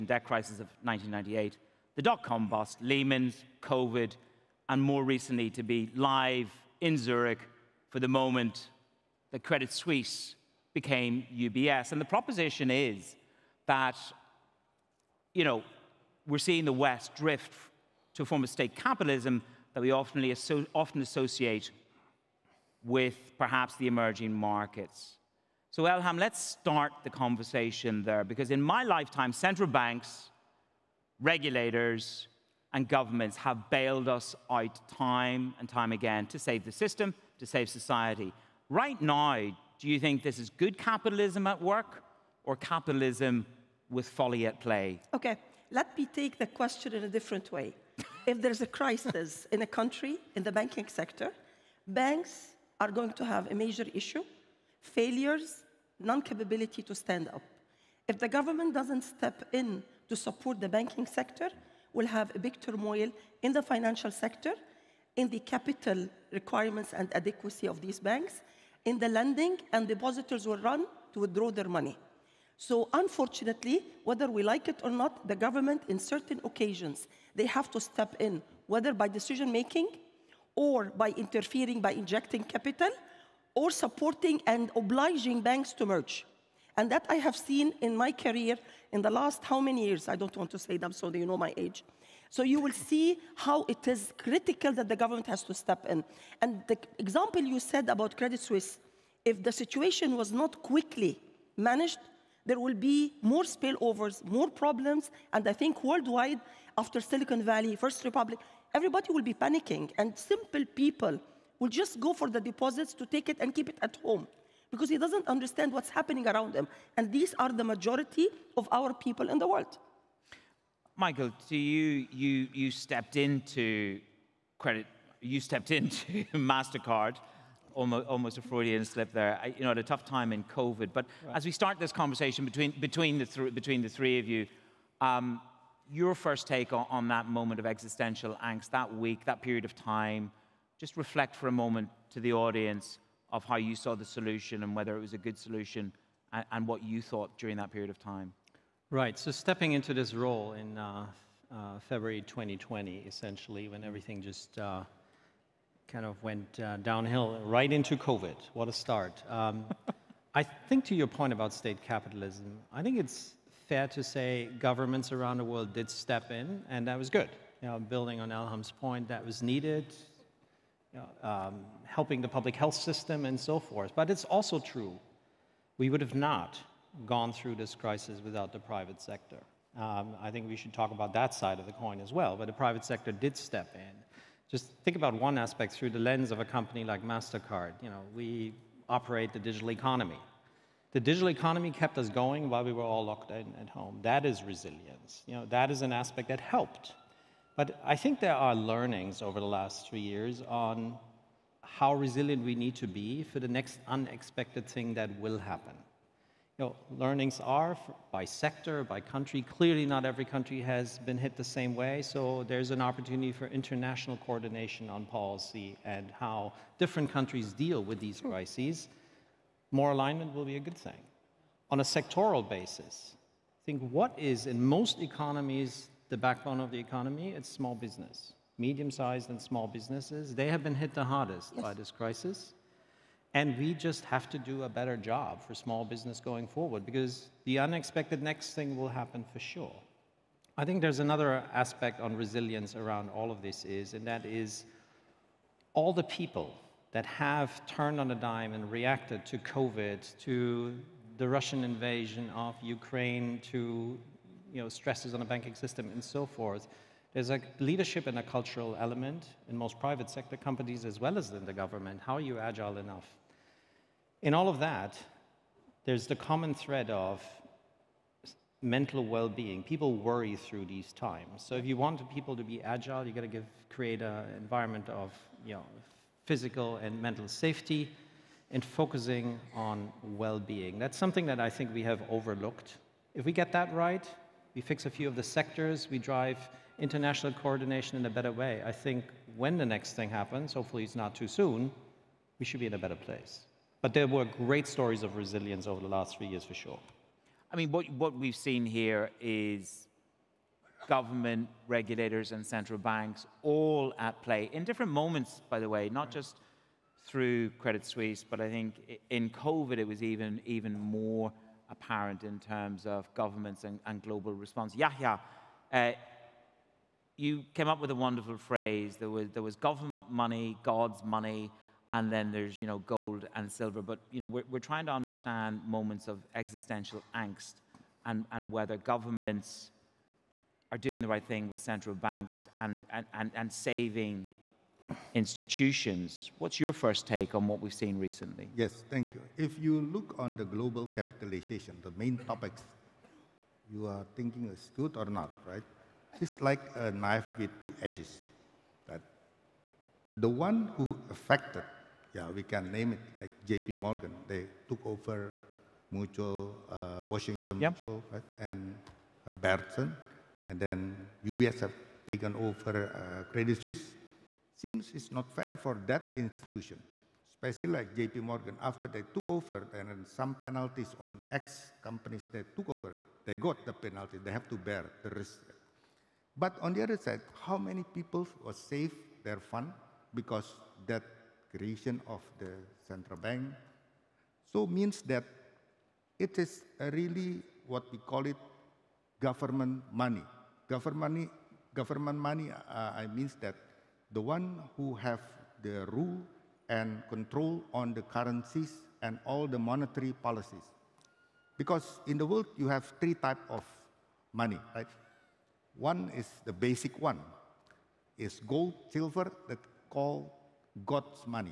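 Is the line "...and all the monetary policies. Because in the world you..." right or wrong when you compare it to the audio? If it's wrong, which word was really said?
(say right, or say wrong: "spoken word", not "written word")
right.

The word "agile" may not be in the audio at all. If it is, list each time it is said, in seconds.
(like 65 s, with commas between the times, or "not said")
262 s, 272 s.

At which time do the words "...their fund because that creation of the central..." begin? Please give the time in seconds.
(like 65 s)
379 s.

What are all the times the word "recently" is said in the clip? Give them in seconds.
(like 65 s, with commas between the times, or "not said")
5 s, 337 s.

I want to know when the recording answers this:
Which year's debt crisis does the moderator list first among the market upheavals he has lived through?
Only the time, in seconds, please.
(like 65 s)
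0 s.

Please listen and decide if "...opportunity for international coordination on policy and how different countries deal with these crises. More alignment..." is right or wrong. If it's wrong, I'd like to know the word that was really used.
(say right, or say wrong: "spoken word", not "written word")
right.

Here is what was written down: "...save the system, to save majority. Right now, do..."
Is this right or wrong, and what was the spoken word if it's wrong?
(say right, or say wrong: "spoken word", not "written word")
wrong: "society", not "majority".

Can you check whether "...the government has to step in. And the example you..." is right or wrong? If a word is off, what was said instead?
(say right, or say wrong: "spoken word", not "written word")
right.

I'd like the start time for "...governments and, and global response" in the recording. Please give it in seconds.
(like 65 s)
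313 s.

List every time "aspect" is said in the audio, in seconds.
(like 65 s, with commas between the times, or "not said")
185 s, 195 s, 241 s.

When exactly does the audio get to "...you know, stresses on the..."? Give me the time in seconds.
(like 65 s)
254 s.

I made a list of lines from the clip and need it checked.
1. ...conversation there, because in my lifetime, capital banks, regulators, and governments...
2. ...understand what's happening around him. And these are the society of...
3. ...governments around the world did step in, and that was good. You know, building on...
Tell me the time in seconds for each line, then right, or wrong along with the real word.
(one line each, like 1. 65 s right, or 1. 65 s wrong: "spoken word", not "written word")
1. 27 s wrong: "central", not "capital"
2. 115 s wrong: "majority", not "society"
3. 164 s right.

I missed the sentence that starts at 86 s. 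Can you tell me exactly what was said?
And that I have seen in my career in the last how many years?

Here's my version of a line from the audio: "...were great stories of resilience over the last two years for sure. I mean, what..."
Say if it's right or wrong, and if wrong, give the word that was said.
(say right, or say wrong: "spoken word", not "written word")
wrong: "three", not "two".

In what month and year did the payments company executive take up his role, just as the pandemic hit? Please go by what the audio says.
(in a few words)
February 2020.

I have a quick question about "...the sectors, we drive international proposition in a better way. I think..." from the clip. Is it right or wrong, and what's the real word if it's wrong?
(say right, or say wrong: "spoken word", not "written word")
wrong: "coordination", not "proposition".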